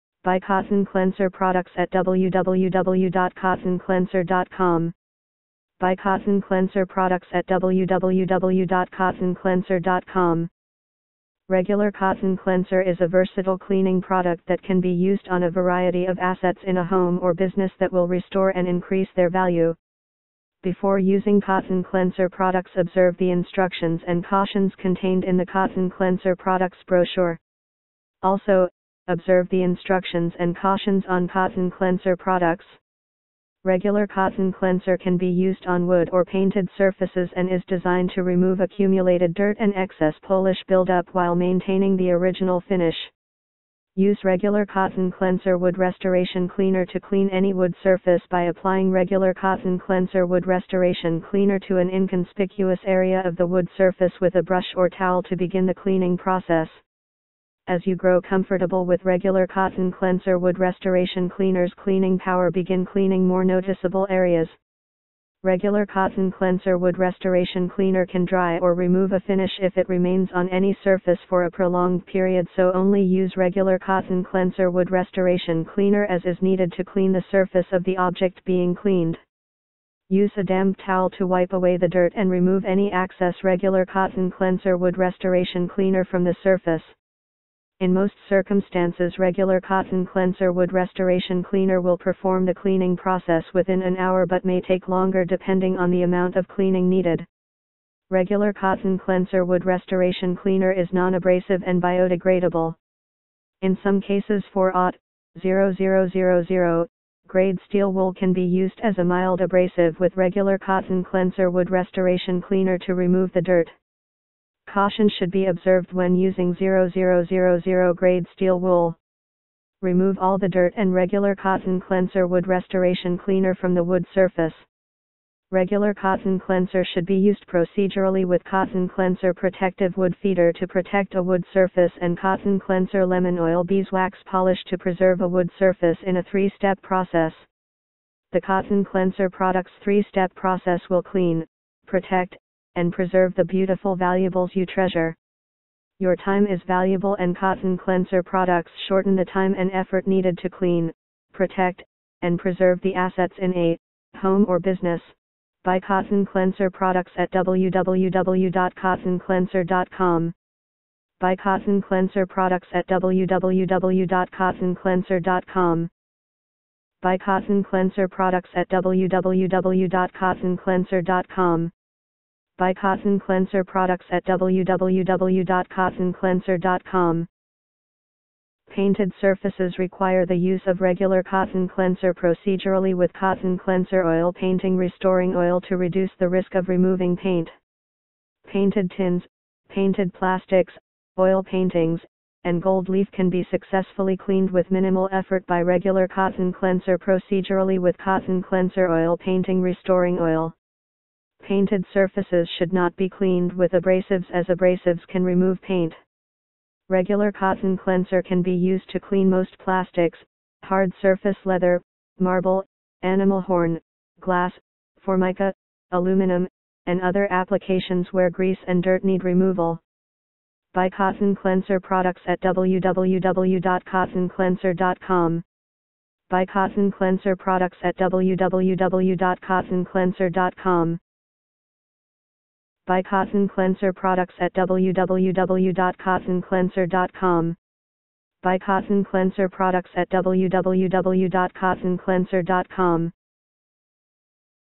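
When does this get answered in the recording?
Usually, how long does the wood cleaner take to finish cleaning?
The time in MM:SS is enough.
01:33.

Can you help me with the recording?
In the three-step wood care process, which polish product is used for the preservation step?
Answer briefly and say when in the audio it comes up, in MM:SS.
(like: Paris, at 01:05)
lemon oil beeswax polish, at 02:13.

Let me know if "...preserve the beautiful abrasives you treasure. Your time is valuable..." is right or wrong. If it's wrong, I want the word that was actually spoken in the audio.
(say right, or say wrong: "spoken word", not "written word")
wrong: "valuables", not "abrasives".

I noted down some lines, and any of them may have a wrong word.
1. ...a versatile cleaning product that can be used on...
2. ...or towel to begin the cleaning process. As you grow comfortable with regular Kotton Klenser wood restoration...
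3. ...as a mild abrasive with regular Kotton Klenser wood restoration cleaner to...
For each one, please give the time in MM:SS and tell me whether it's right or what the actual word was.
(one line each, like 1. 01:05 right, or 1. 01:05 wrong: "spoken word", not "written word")
1. 00:13 right
2. 00:54 right
3. 01:48 right.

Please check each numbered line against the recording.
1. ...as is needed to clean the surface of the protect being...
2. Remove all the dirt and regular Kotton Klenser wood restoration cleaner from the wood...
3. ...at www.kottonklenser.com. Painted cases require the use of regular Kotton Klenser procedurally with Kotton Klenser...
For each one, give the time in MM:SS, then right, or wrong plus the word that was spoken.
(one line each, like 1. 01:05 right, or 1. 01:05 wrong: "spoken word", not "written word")
1. 01:16 wrong: "object", not "protect"
2. 01:59 right
3. 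02:54 wrong: "surfaces", not "cases".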